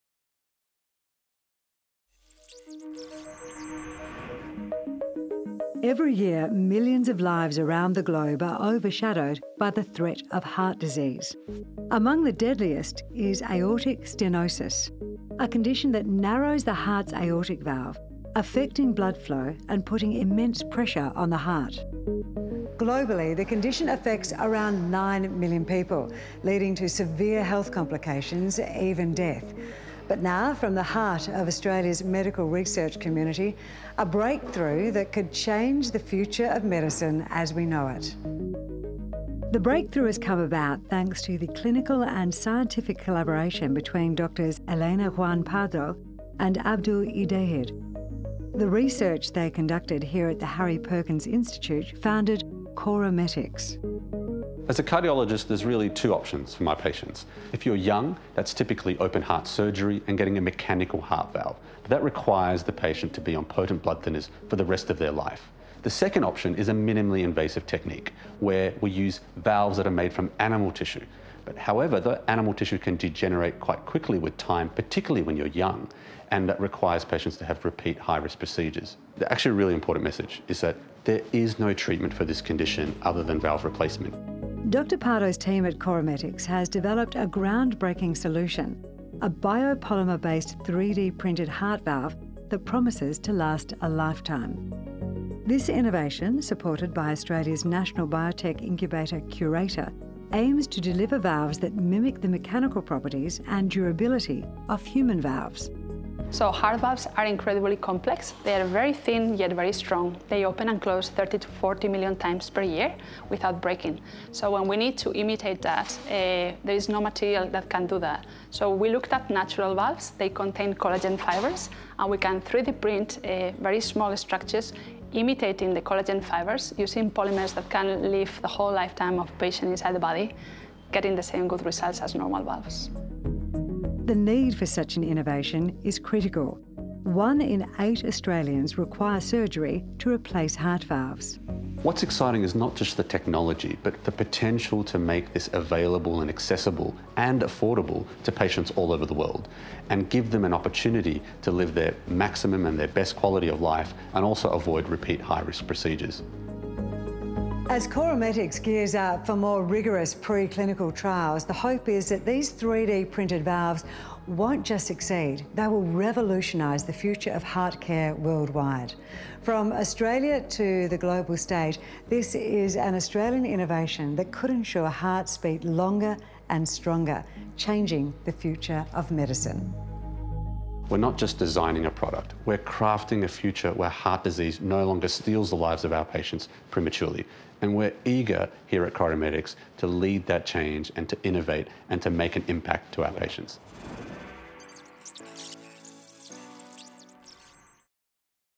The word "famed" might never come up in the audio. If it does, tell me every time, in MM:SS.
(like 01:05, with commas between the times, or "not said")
not said.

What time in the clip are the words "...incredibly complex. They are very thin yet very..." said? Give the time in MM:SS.
01:47.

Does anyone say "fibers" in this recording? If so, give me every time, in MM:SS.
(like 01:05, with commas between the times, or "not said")
02:01, 02:06.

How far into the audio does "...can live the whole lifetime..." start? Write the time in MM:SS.
02:07.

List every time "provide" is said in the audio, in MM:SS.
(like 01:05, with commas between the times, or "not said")
not said.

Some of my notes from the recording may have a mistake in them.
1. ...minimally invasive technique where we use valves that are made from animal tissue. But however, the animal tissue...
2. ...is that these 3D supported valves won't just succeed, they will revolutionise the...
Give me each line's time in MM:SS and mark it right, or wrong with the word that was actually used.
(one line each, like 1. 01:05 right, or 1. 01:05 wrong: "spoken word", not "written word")
1. 01:06 right
2. 02:41 wrong: "printed", not "supported".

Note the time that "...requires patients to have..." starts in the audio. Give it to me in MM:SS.
01:16.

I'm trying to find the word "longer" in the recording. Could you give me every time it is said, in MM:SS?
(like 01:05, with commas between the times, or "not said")
02:55, 03:04.